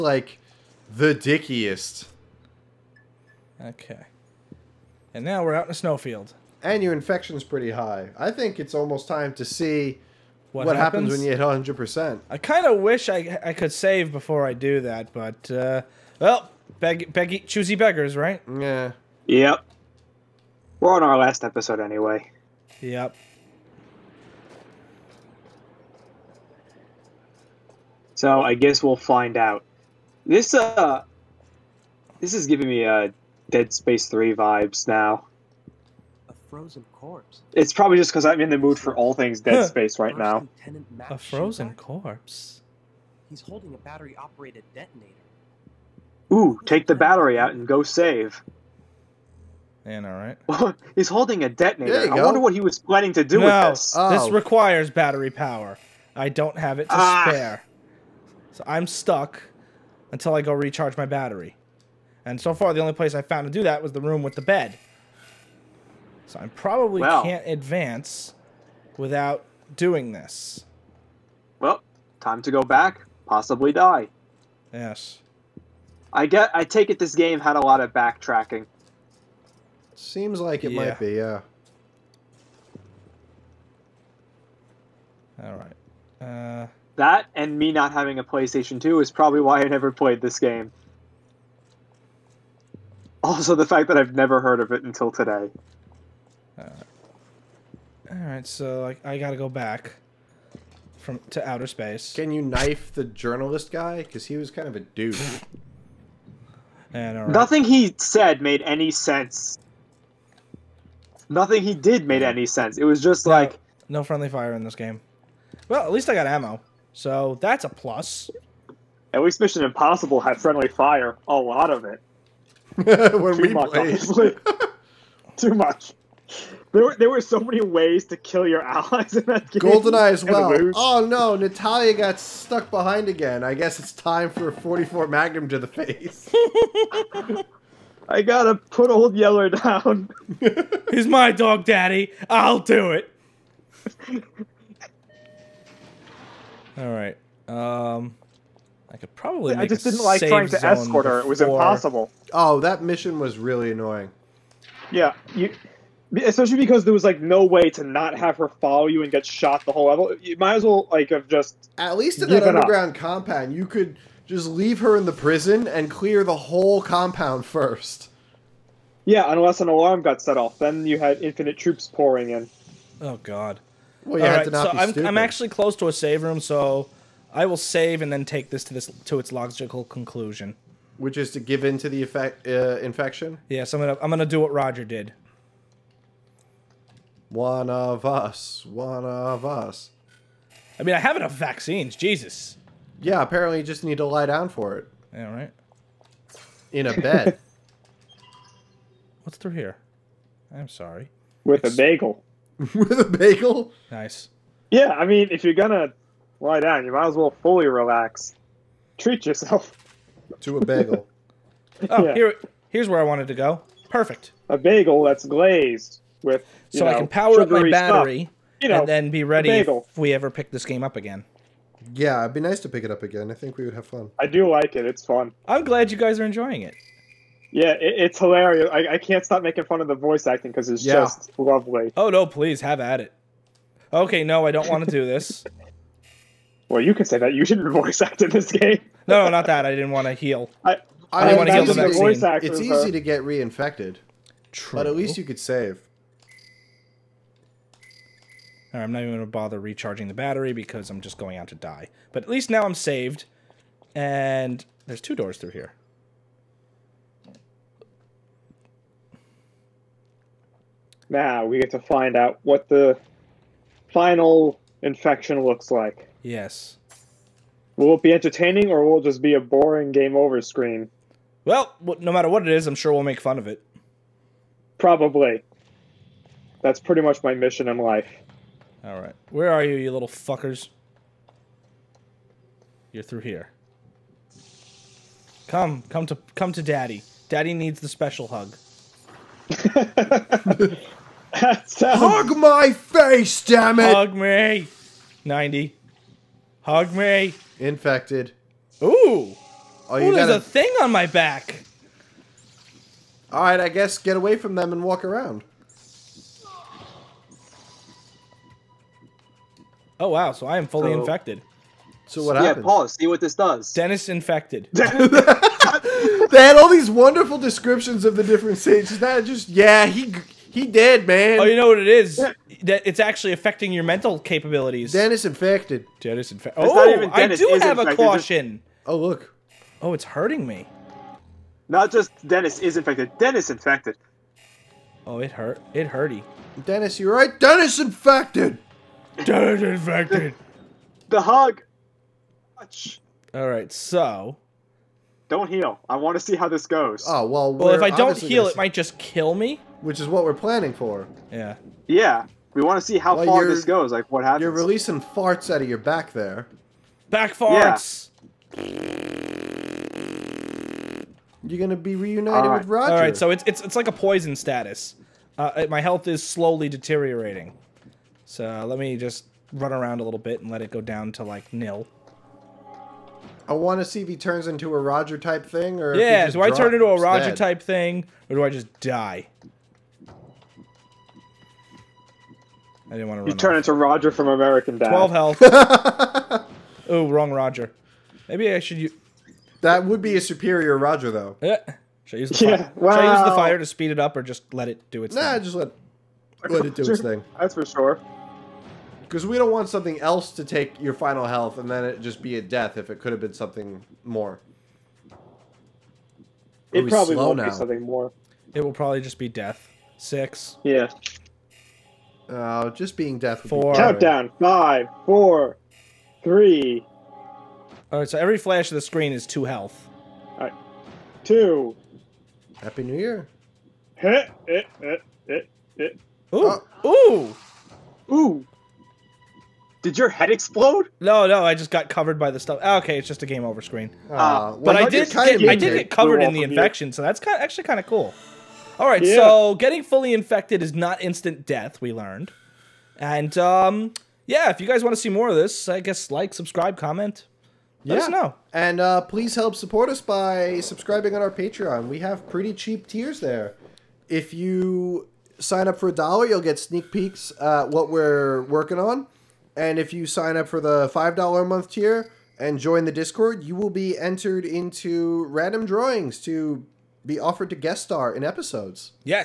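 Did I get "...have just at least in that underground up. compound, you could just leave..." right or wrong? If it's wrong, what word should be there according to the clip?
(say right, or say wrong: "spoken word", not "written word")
right.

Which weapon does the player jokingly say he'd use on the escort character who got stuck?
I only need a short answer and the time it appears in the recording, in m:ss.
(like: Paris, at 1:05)
44 Magnum, at 2:14.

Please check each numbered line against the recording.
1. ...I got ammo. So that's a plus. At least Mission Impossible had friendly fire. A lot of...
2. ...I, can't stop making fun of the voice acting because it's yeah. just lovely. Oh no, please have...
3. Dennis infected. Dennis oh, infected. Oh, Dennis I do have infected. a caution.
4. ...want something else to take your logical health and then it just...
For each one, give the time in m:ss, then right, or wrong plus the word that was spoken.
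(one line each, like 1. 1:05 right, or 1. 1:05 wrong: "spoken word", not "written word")
1. 1:56 right
2. 3:48 right
3. 5:24 right
4. 6:39 wrong: "final", not "logical".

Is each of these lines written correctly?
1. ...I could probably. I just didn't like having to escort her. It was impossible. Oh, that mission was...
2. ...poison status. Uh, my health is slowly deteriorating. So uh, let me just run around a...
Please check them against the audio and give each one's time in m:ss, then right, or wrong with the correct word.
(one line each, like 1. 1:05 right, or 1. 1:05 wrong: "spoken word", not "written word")
1. 2:28 wrong: "trying", not "having"
2. 6:03 right.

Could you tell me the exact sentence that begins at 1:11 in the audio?
Well, time to go back, possibly die.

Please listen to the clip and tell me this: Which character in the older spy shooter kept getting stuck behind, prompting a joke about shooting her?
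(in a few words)
Natalia.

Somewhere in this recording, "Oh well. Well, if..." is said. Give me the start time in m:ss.
5:47.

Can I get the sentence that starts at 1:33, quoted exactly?
Also, the fact that I've never heard of it until today.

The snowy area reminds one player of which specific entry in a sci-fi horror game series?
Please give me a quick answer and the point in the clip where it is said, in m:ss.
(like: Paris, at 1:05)
Dead Space Three, at 0:33.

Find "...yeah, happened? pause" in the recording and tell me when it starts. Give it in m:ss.
5:12.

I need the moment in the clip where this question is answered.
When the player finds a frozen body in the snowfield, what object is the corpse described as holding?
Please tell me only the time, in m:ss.
0:43.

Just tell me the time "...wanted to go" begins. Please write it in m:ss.
3:33.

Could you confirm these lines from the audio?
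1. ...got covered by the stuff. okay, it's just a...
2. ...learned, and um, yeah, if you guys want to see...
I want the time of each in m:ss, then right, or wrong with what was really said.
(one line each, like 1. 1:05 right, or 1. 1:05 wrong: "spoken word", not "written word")
1. 7:11 right
2. 7:21 right.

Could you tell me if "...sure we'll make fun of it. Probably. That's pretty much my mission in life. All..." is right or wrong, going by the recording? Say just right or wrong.
right.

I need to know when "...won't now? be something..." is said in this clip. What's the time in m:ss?
6:47.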